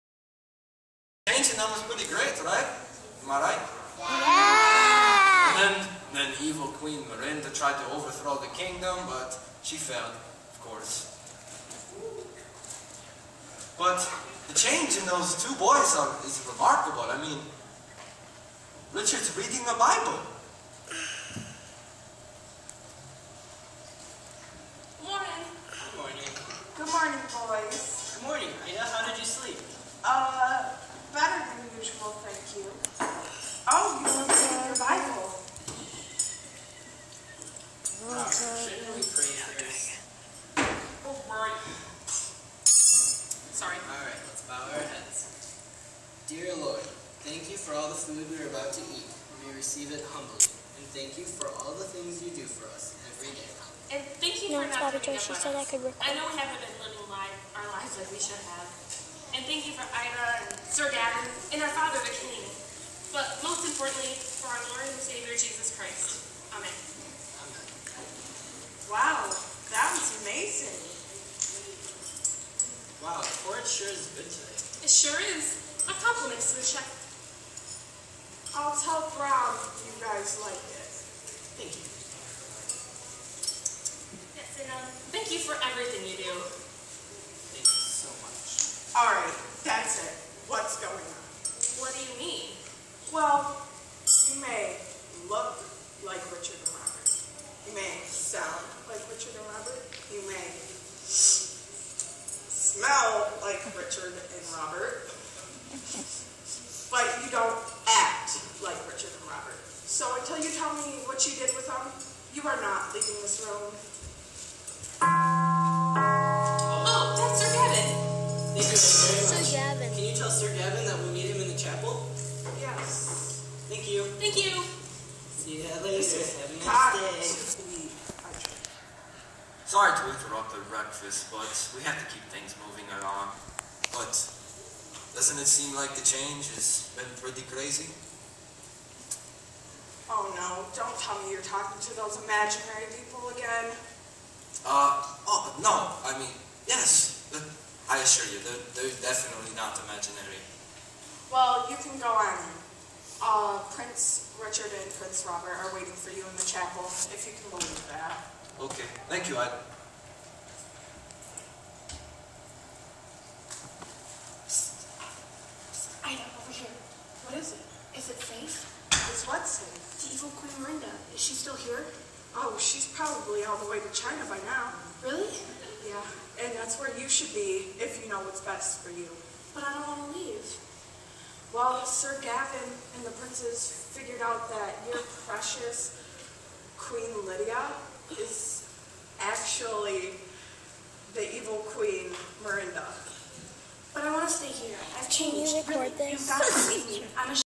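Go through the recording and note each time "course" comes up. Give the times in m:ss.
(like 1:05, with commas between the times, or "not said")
0:10.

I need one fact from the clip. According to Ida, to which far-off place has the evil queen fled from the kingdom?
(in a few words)
China.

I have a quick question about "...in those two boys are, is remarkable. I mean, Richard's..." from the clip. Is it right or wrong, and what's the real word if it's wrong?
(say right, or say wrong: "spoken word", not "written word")
right.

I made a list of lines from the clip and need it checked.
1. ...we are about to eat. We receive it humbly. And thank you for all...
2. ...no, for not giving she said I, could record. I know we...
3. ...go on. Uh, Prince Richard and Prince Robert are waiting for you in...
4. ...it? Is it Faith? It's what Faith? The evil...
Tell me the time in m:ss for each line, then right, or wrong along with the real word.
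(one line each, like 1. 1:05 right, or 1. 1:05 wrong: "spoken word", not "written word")
1. 0:48 right
2. 0:54 right
3. 2:31 right
4. 2:47 right.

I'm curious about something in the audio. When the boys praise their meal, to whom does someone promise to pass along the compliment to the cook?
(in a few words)
Brown.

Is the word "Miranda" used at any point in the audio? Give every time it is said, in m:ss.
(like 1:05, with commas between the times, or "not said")
0:07, 3:12.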